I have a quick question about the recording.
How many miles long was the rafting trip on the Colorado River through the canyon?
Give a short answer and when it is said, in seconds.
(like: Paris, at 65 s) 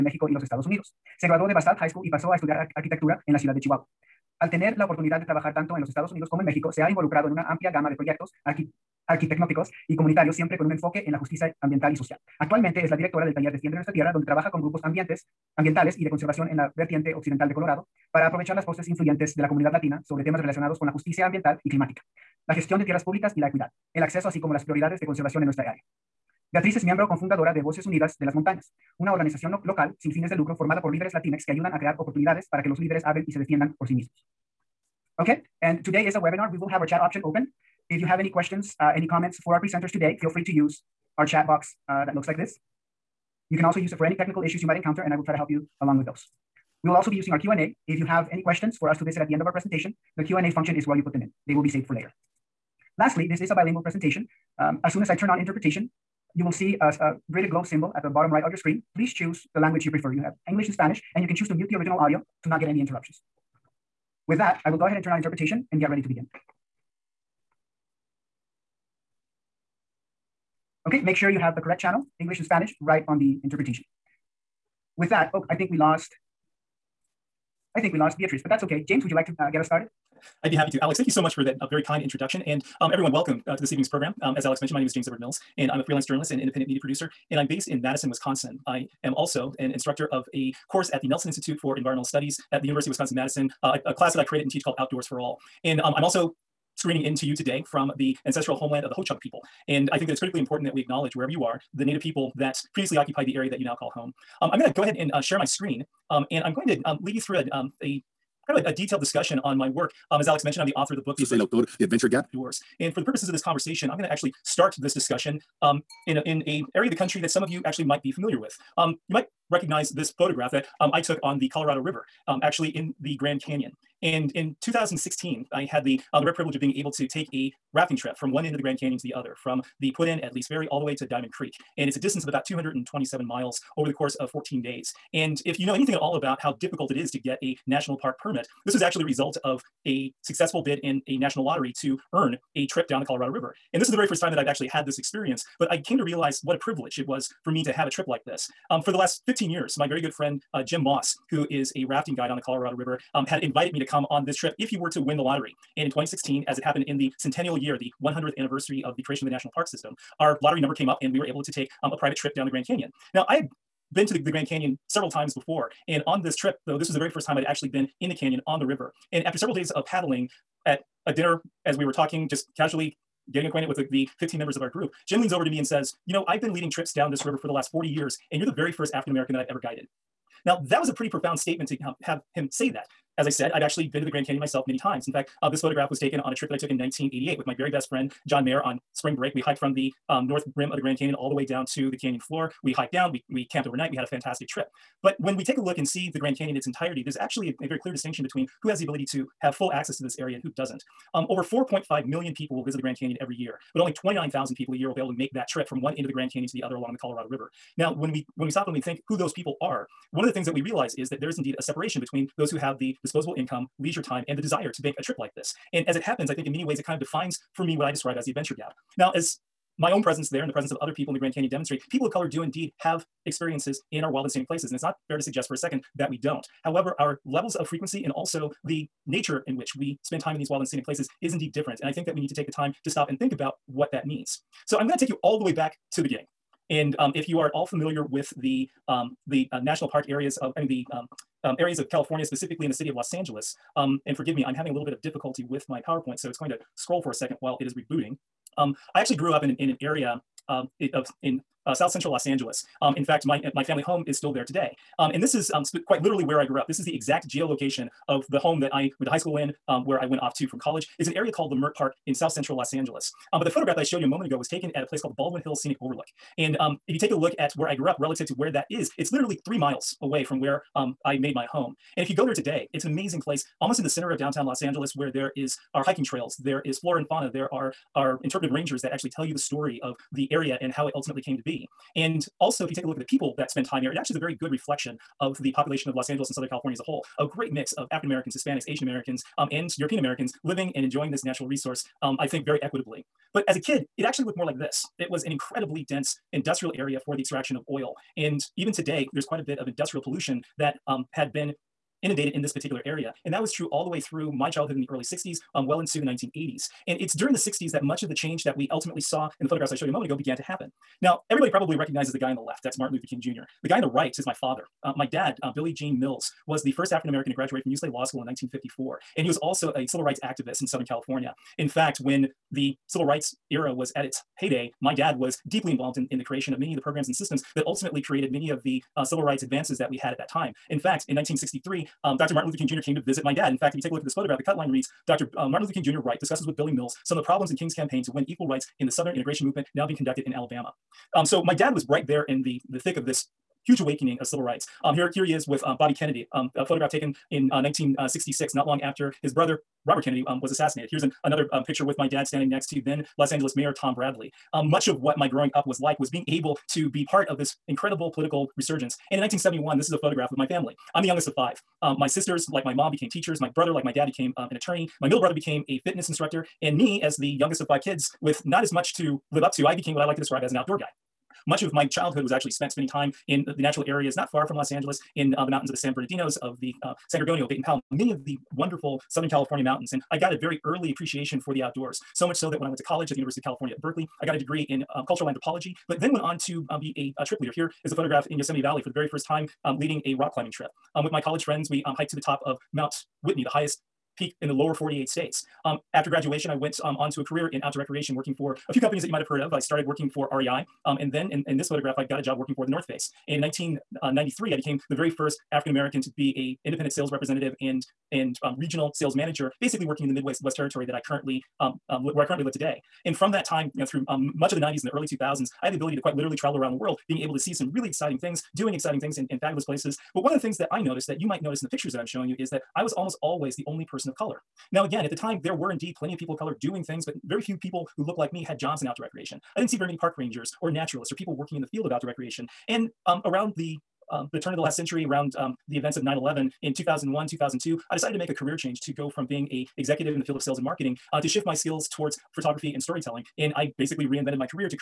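227 miles, at 132 s.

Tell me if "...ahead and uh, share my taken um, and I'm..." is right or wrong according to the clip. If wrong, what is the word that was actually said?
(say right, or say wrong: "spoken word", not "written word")
wrong: "screen", not "taken".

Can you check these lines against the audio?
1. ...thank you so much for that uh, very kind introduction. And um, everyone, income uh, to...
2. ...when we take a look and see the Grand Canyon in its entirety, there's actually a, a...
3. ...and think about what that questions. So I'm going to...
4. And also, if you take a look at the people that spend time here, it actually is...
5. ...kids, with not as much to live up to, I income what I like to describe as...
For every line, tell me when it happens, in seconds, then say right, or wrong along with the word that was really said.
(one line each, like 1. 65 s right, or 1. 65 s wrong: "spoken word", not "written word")
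1. 80 s wrong: "welcome", not "income"
2. 195 s right
3. 233 s wrong: "means", not "questions"
4. 281 s right
5. 367 s wrong: "became", not "income".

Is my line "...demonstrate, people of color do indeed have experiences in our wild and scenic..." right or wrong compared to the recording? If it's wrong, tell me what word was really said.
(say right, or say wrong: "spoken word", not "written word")
right.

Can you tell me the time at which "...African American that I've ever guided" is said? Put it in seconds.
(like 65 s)
178 s.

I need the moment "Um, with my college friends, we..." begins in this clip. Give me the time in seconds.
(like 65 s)
390 s.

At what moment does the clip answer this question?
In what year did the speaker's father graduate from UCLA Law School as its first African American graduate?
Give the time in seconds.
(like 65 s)
318 s.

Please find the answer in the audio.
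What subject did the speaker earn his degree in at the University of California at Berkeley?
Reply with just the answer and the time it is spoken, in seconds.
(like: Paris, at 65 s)
Cultural anthropology, at 385 s.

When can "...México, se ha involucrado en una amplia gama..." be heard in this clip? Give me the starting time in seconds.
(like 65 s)
6 s.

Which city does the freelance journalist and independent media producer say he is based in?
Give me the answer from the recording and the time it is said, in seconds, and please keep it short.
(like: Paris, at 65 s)
Madison, Wisconsin, at 87 s.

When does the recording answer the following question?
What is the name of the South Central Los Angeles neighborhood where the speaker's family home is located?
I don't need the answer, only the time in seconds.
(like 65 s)
261 s.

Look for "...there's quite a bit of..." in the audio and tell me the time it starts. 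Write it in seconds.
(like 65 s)
299 s.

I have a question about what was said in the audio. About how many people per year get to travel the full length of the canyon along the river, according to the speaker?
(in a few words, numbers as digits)
29,000.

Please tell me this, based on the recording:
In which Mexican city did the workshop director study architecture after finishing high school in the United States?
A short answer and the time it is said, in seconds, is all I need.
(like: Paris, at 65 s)
Chihuahua, at 3 s.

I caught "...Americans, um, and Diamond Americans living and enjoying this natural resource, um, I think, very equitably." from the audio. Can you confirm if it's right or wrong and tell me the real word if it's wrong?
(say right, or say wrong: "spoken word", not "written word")
wrong: "European", not "Diamond".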